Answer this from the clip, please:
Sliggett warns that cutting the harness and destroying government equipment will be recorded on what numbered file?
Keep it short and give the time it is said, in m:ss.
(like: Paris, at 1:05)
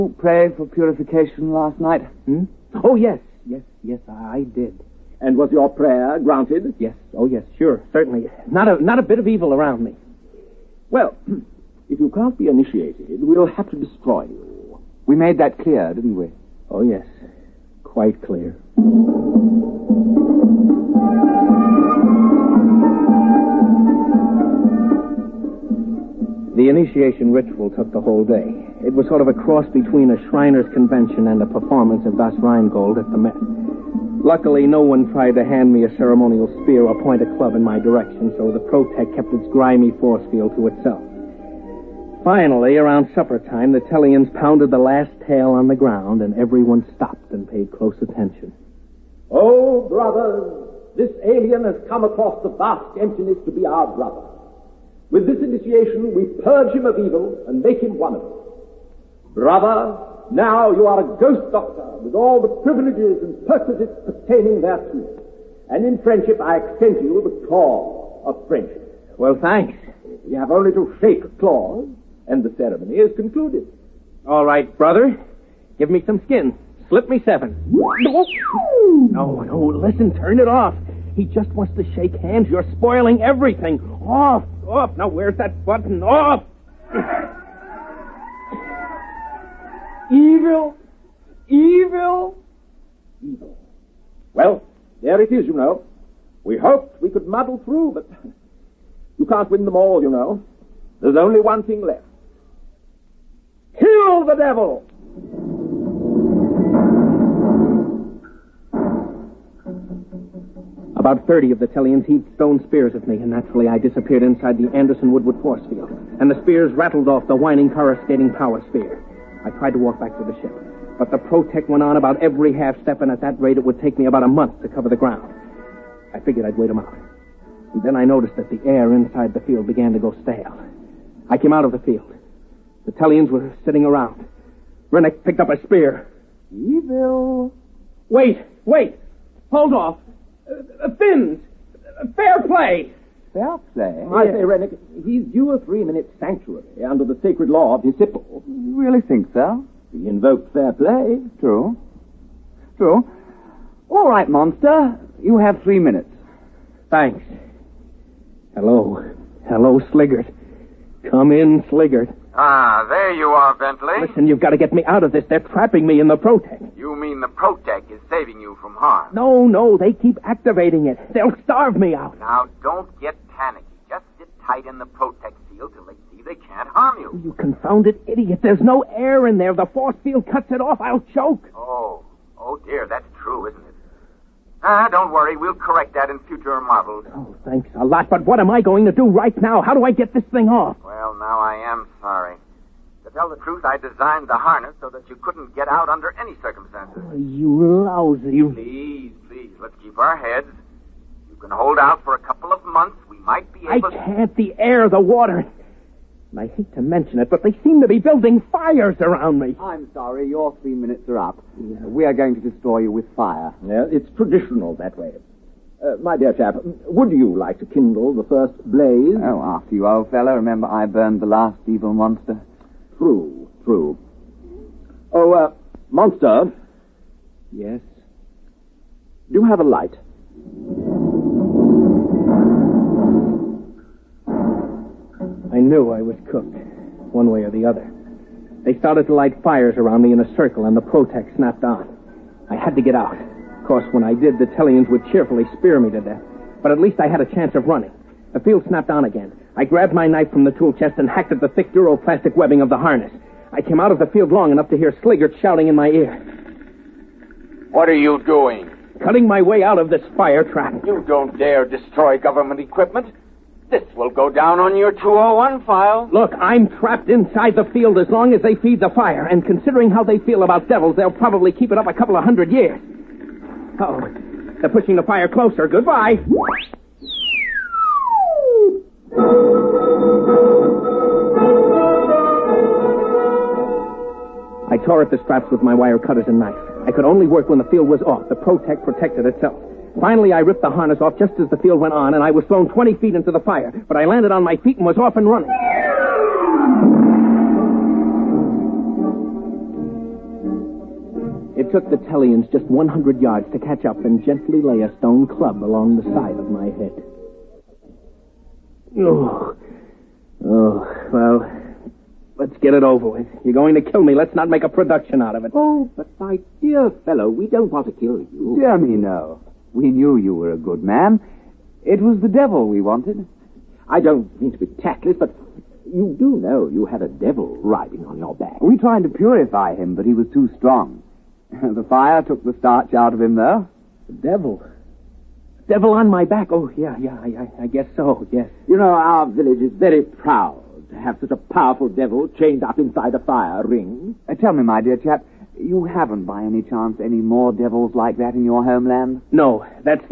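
201 file, at 4:24.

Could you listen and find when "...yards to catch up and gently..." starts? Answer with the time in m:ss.
5:03.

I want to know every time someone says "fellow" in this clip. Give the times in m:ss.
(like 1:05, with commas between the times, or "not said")
3:40, 5:17.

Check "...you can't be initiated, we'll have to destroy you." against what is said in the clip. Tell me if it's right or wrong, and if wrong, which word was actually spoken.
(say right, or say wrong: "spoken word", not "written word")
right.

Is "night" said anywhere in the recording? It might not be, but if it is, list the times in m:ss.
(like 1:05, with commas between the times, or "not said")
0:01.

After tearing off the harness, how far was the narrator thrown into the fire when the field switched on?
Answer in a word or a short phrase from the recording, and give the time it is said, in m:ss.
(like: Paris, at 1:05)
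20 feet, at 4:52.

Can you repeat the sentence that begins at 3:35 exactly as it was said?
Uh, my dear chap, would you like to kindle the first blaze?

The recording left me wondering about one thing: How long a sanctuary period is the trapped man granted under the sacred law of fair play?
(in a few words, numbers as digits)
3 minutes.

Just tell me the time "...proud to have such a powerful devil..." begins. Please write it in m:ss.
5:40.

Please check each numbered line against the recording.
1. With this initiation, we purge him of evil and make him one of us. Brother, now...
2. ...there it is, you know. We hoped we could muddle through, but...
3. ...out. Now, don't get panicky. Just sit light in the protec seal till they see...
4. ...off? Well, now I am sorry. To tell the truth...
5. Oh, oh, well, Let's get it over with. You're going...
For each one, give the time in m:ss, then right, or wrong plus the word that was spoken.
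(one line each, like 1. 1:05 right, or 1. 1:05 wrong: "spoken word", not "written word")
1. 0:55 right
2. 1:35 right
3. 2:51 wrong: "tight", not "light"
4. 3:10 right
5. 5:08 right.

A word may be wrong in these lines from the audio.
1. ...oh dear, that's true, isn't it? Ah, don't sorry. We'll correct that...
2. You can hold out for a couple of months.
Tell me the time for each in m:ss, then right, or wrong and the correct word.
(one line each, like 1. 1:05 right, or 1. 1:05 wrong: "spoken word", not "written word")
1. 3:02 wrong: "worry", not "sorry"
2. 3:21 right.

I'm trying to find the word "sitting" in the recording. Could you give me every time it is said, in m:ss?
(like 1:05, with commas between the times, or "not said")
2:13.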